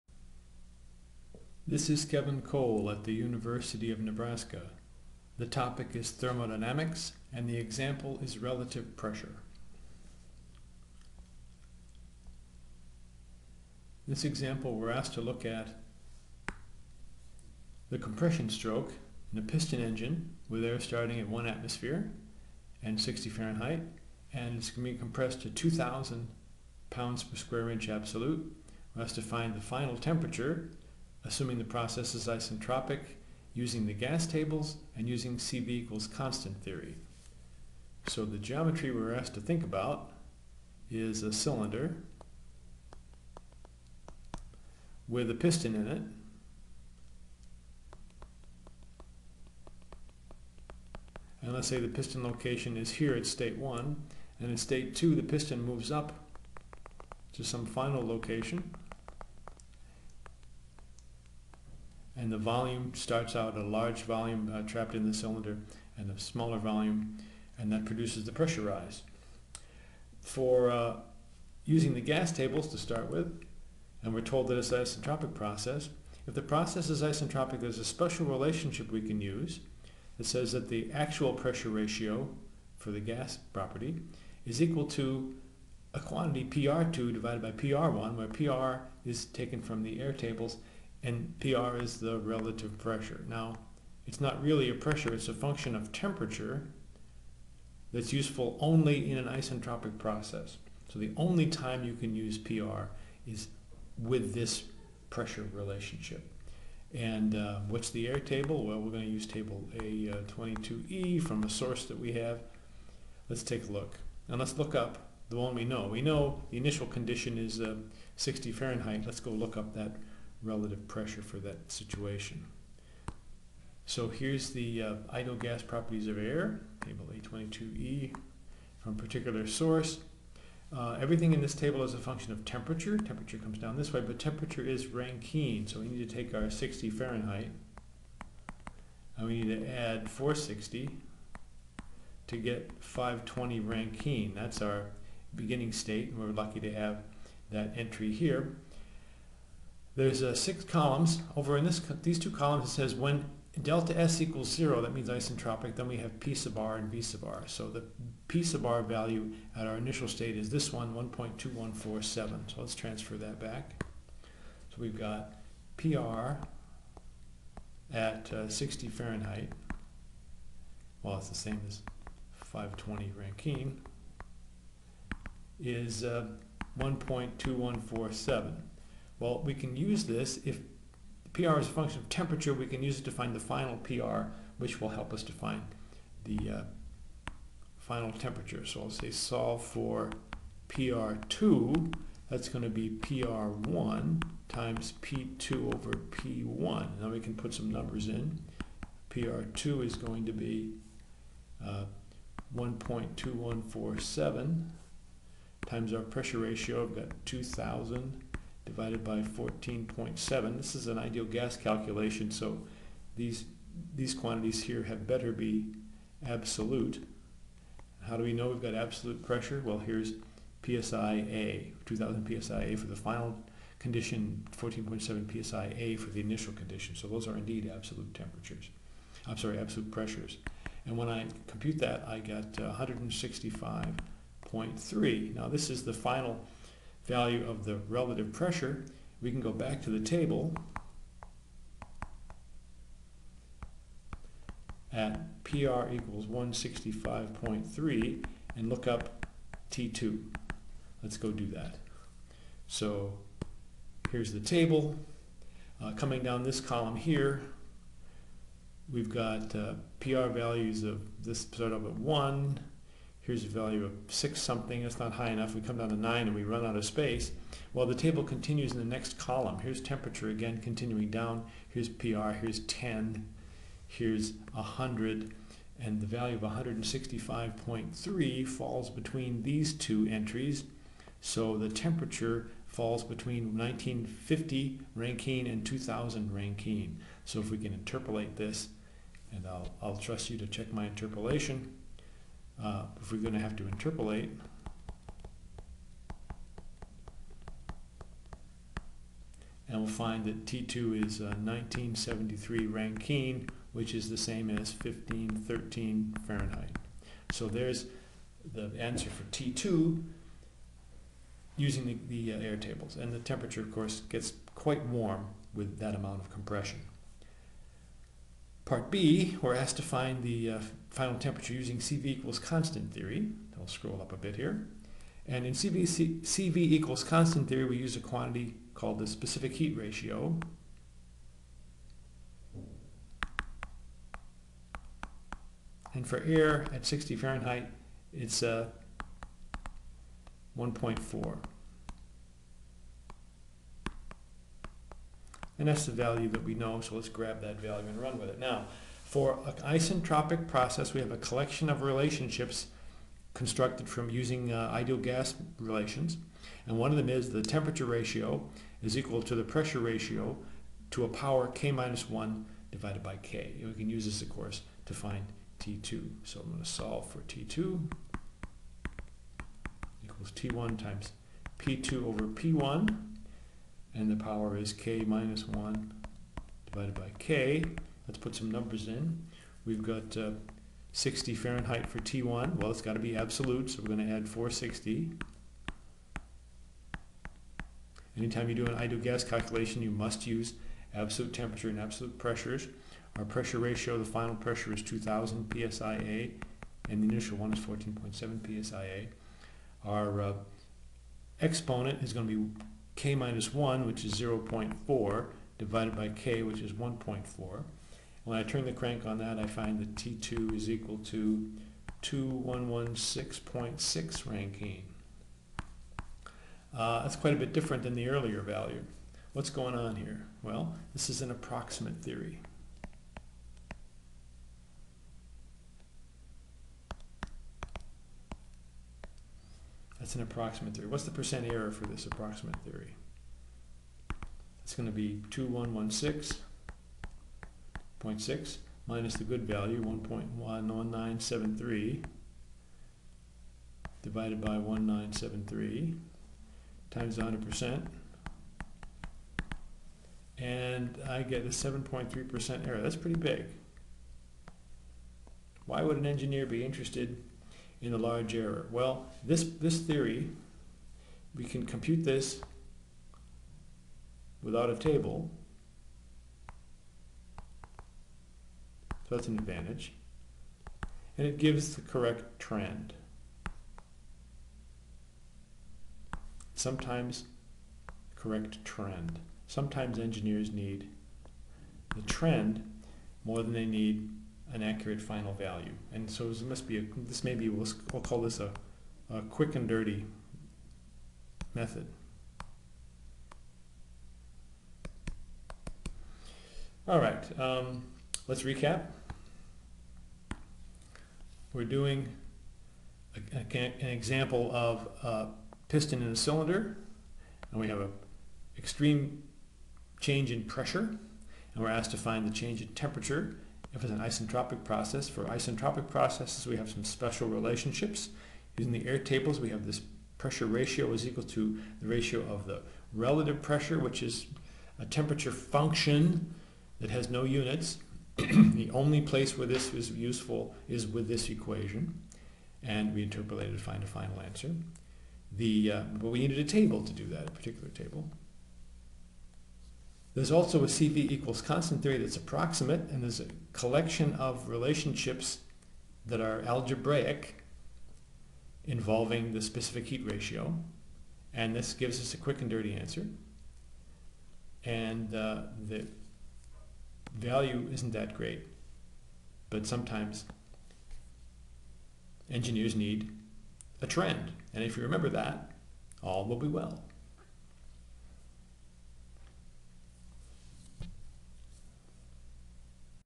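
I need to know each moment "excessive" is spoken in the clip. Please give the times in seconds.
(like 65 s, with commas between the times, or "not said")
not said.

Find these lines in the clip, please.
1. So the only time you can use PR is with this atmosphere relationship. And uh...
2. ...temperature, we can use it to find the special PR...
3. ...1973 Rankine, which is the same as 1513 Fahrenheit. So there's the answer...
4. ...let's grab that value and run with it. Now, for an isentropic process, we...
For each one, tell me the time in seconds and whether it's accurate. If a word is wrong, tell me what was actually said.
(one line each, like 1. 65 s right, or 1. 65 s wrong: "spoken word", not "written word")
1. 100 s wrong: "pressure", not "atmosphere"
2. 182 s wrong: "final", not "special"
3. 301 s right
4. 346 s right.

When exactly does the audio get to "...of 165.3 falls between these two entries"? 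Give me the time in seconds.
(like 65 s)
276 s.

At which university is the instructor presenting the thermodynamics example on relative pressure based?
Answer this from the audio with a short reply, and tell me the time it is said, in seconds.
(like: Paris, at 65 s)
University of Nebraska, at 3 s.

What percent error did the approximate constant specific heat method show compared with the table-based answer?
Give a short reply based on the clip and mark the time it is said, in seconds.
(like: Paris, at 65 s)
7.3%, at 451 s.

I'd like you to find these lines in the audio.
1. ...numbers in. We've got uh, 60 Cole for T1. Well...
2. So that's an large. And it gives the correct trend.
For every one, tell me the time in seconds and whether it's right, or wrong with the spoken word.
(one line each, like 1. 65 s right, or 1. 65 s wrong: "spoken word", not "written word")
1. 378 s wrong: "Fahrenheit", not "Cole"
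2. 469 s wrong: "advantage", not "large".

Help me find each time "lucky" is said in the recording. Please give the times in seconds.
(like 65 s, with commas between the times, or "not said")
146 s.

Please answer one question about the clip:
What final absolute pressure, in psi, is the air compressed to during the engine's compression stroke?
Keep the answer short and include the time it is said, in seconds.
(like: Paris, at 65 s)
2000, at 25 s.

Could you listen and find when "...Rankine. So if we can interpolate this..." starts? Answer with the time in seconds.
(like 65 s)
286 s.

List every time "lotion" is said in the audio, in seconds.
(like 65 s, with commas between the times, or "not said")
not said.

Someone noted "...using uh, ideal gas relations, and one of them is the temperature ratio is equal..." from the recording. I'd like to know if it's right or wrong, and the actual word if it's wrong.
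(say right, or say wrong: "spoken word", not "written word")
right.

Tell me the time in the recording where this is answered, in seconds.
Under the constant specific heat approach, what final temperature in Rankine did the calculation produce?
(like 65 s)
412 s.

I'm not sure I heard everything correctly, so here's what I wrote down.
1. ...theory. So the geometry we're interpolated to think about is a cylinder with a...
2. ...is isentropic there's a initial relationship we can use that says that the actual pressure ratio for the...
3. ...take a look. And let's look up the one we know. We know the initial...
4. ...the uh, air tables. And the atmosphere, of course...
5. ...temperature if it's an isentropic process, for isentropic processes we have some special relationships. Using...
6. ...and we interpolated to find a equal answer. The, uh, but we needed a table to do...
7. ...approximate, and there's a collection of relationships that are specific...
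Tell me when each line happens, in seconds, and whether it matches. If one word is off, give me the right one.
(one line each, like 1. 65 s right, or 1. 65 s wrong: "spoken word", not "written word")
1. 36 s wrong: "asked", not "interpolated"
2. 76 s wrong: "special", not "initial"
3. 113 s right
4. 312 s wrong: "temperature", not "atmosphere"
5. 512 s right
6. 532 s wrong: "final", not "equal"
7. 542 s wrong: "algebraic", not "specific".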